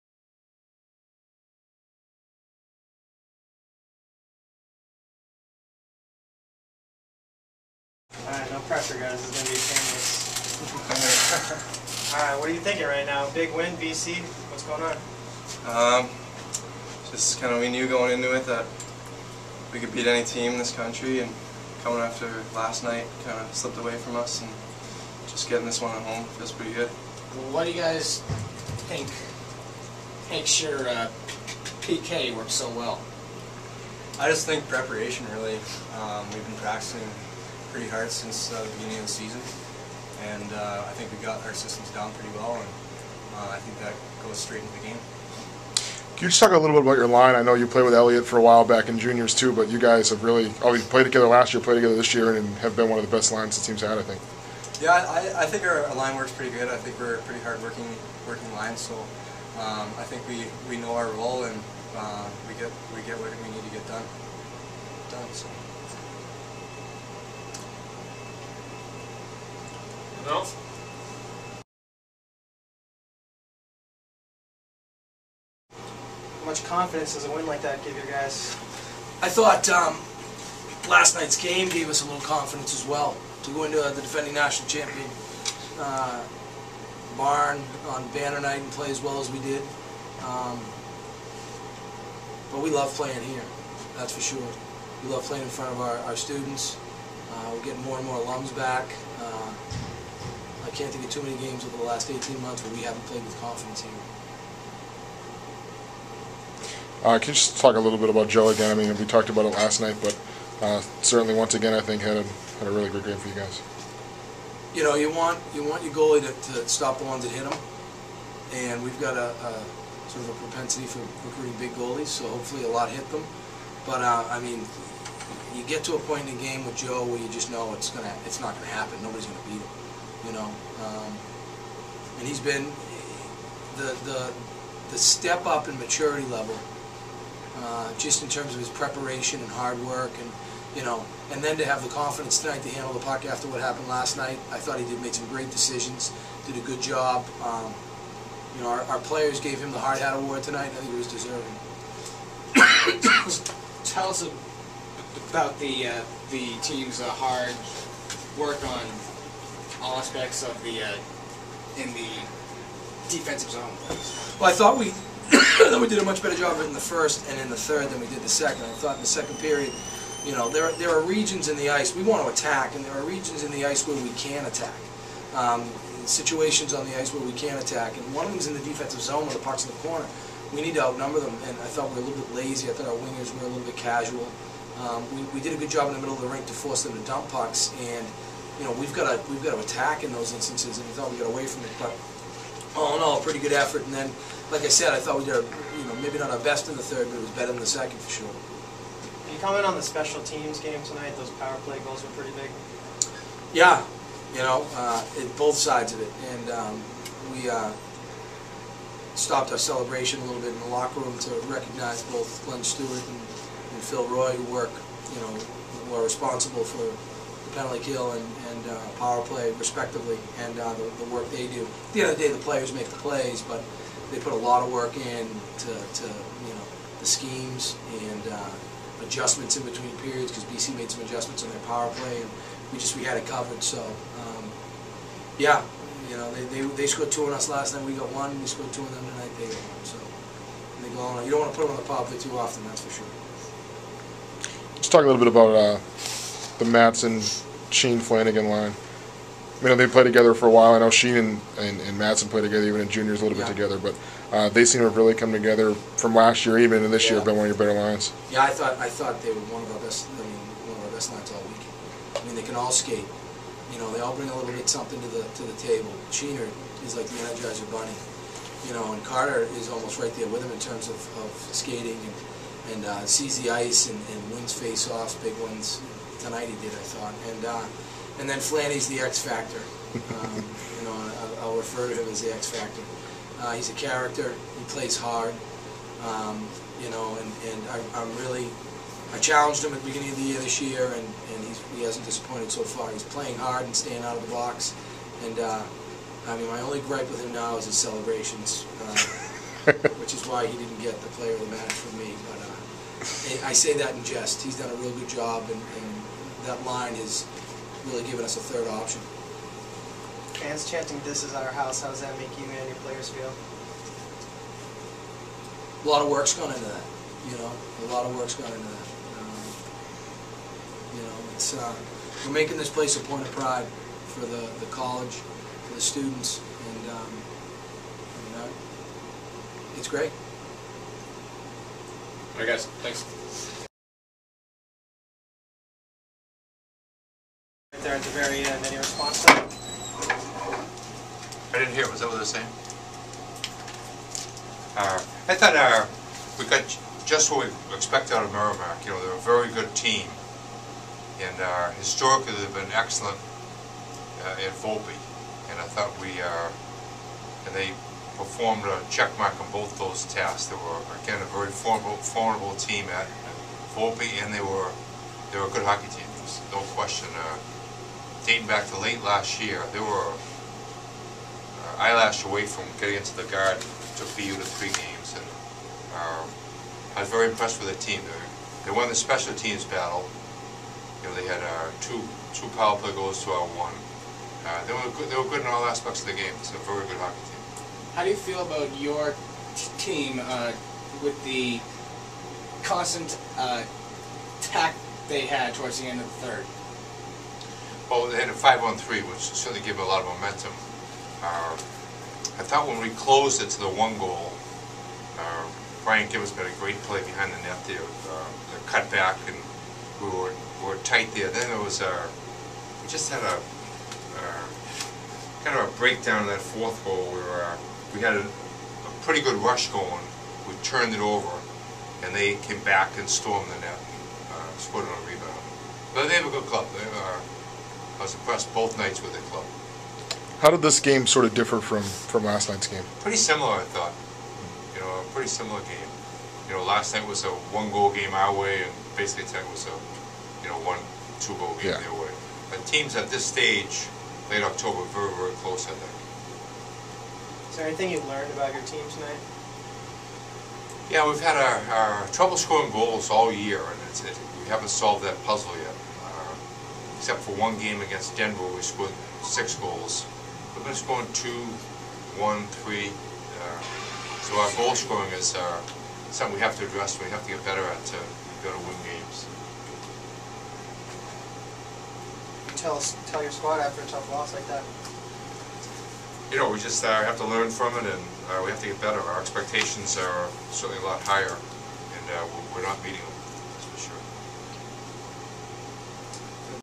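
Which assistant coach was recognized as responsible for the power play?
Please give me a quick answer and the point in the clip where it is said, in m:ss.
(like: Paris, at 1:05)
Phil Roy, at 3:33.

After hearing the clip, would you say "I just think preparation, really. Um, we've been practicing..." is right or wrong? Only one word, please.
right.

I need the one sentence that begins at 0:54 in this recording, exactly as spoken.
Yeah, I, I think our, line works pretty good.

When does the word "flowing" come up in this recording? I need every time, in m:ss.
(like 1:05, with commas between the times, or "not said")
not said.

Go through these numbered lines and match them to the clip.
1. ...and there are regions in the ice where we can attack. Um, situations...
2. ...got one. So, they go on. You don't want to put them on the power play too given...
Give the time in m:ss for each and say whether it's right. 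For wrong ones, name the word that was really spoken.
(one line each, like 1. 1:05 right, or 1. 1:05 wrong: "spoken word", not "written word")
1. 2:52 right
2. 3:59 wrong: "often", not "given".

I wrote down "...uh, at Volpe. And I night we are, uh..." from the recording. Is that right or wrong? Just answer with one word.
wrong.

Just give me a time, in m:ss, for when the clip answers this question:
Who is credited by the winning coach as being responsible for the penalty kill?
3:32.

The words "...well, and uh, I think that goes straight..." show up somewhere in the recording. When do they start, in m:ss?
0:42.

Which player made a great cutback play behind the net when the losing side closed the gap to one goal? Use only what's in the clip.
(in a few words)
Brian Gibbons.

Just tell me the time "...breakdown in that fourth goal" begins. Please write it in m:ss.
6:55.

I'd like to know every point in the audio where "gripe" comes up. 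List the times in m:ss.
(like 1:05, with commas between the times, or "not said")
4:56.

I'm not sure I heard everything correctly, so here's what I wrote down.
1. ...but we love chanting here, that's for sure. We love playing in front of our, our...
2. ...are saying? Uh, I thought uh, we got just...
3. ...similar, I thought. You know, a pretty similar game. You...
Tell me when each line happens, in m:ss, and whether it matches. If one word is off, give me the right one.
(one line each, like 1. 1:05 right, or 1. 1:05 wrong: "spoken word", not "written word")
1. 1:32 wrong: "playing", not "chanting"
2. 5:42 right
3. 7:13 right.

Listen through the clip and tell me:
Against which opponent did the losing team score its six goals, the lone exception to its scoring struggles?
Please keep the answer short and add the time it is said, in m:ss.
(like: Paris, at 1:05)
Denver, at 7:38.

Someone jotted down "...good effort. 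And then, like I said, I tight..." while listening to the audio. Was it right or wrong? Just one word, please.
wrong.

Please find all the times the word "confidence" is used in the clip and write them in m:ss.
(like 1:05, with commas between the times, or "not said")
1:16, 1:22, 1:43, 2:21.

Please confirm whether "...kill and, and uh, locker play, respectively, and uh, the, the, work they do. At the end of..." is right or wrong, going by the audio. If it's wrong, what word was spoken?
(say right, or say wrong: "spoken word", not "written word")
wrong: "power", not "locker".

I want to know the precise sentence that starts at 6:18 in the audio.
They, they won the special teams battle.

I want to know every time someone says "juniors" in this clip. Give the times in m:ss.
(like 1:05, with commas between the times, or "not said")
0:48, 4:12.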